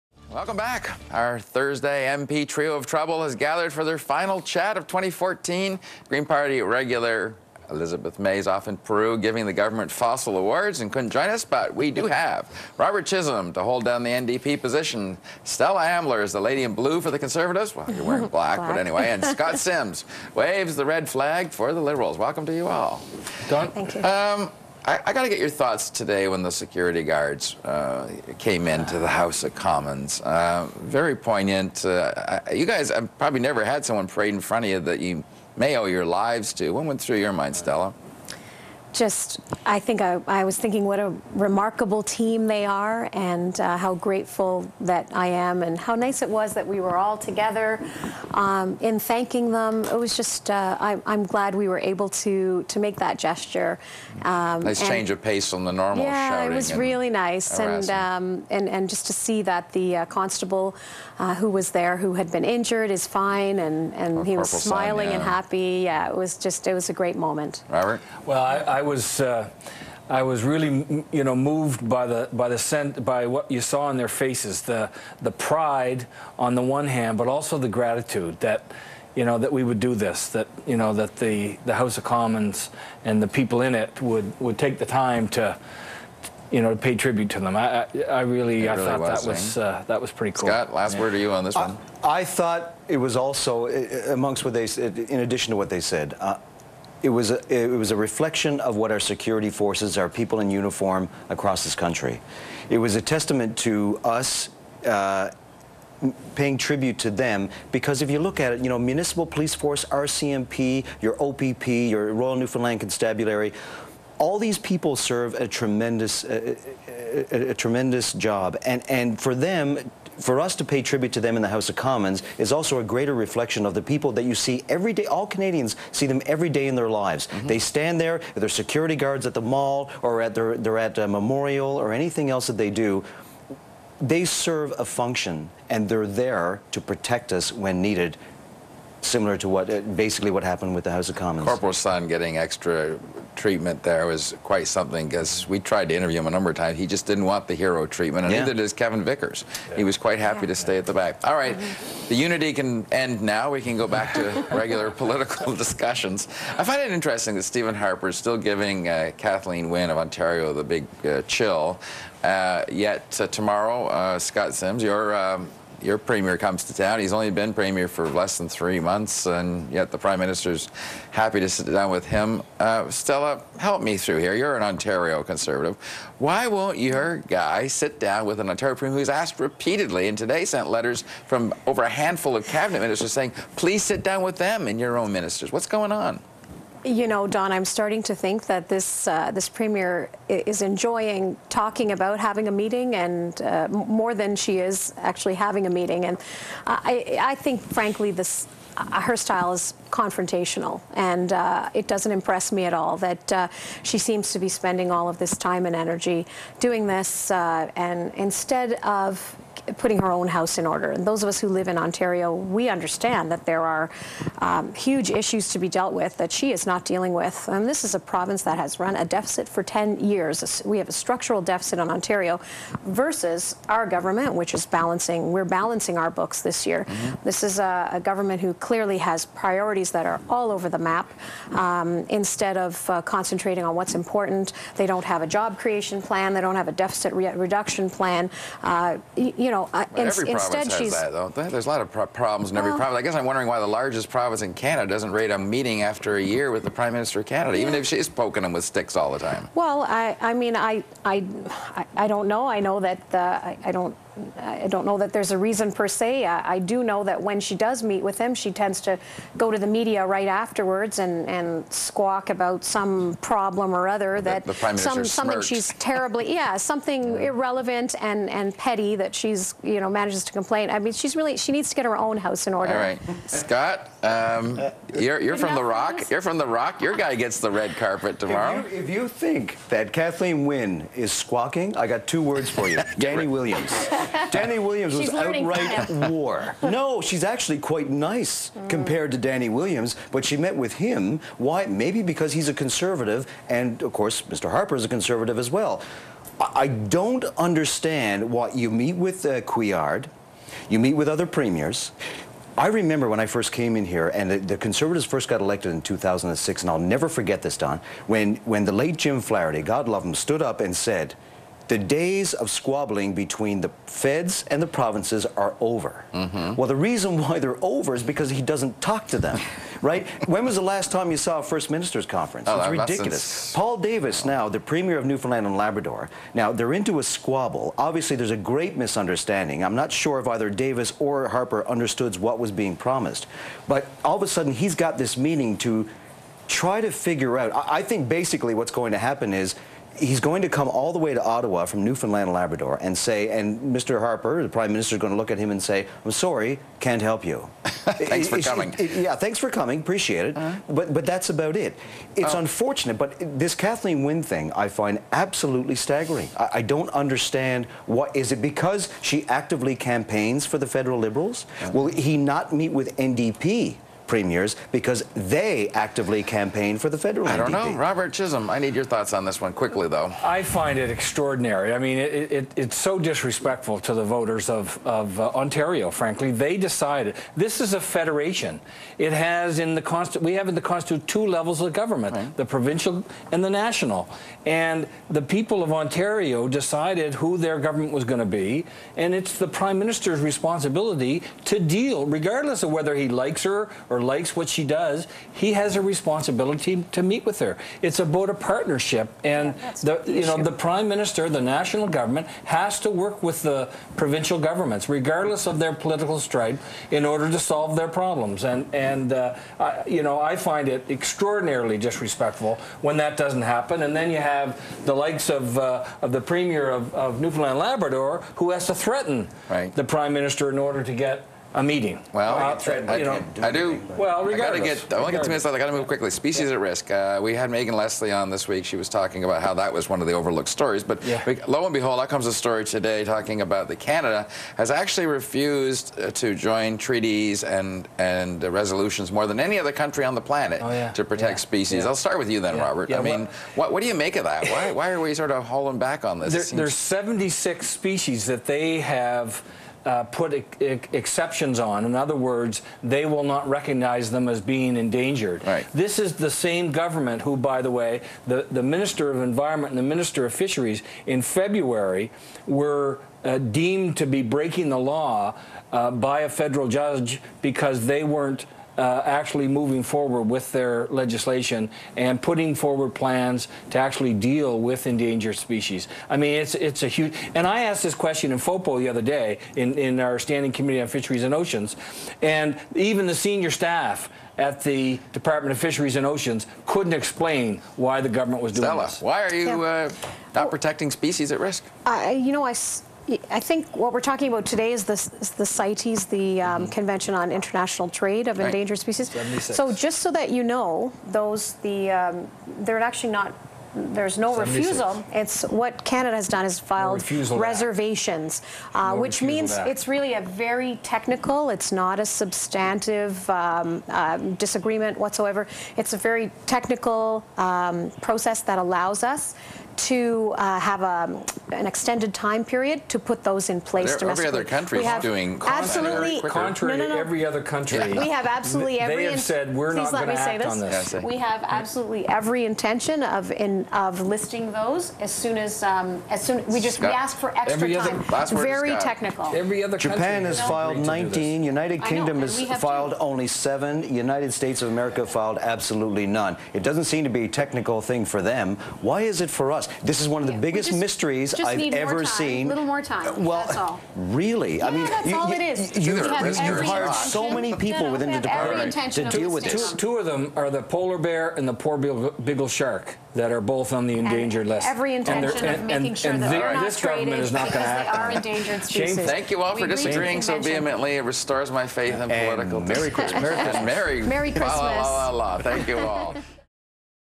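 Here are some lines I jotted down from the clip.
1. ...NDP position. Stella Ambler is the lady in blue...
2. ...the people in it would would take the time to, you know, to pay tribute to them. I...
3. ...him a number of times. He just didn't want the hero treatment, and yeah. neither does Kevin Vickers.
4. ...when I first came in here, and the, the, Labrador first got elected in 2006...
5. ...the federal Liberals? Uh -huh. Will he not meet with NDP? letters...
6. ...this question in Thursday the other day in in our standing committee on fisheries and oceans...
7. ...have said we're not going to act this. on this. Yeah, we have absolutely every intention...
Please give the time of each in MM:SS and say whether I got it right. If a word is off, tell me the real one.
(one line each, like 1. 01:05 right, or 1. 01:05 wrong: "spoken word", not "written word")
1. 00:14 right
2. 01:23 right
3. 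02:26 right
4. 05:03 wrong: "Conservatives", not "Labrador"
5. 06:00 wrong: "premiers", not "letters"
6. 07:57 wrong: "FOPO", not "Thursday"
7. 08:49 right.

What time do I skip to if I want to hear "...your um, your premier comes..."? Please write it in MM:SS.
02:44.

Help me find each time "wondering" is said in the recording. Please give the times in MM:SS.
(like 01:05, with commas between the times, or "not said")
04:03.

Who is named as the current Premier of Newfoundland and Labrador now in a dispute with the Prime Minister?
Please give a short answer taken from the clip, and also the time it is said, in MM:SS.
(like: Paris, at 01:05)
Paul Davis, at 05:23.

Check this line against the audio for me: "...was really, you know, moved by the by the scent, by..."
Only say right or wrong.
right.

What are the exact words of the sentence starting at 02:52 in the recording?
Uh, Stella, help me through here.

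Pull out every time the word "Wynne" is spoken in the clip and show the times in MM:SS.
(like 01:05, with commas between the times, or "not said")
02:39, 04:40, 05:54.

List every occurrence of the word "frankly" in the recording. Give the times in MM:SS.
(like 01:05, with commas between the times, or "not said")
03:17, 06:15.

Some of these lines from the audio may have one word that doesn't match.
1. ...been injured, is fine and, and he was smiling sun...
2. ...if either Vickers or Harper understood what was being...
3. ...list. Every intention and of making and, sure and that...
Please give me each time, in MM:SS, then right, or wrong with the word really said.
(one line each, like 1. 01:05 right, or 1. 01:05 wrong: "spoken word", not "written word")
1. 01:02 right
2. 05:30 wrong: "Davis", not "Vickers"
3. 09:24 right.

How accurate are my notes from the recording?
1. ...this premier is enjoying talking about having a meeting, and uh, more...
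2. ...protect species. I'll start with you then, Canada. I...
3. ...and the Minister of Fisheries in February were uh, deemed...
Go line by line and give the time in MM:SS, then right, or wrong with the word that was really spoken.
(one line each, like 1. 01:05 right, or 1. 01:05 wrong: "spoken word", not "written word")
1. 03:09 right
2. 07:21 wrong: "Robert", not "Canada"
3. 07:39 right.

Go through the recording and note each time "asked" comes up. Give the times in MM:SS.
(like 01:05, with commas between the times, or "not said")
02:59, 07:57.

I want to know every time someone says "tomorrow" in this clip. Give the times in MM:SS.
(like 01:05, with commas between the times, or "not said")
02:43, 04:38.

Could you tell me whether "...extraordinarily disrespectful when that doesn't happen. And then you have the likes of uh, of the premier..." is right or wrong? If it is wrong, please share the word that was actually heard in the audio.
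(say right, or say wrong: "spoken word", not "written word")
right.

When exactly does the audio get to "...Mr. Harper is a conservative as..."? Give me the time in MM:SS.
04:54.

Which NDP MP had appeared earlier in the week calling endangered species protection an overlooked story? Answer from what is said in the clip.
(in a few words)
Megan Leslie.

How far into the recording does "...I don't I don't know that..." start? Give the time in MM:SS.
04:13.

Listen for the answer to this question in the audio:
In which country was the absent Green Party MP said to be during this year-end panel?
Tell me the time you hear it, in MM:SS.
00:08.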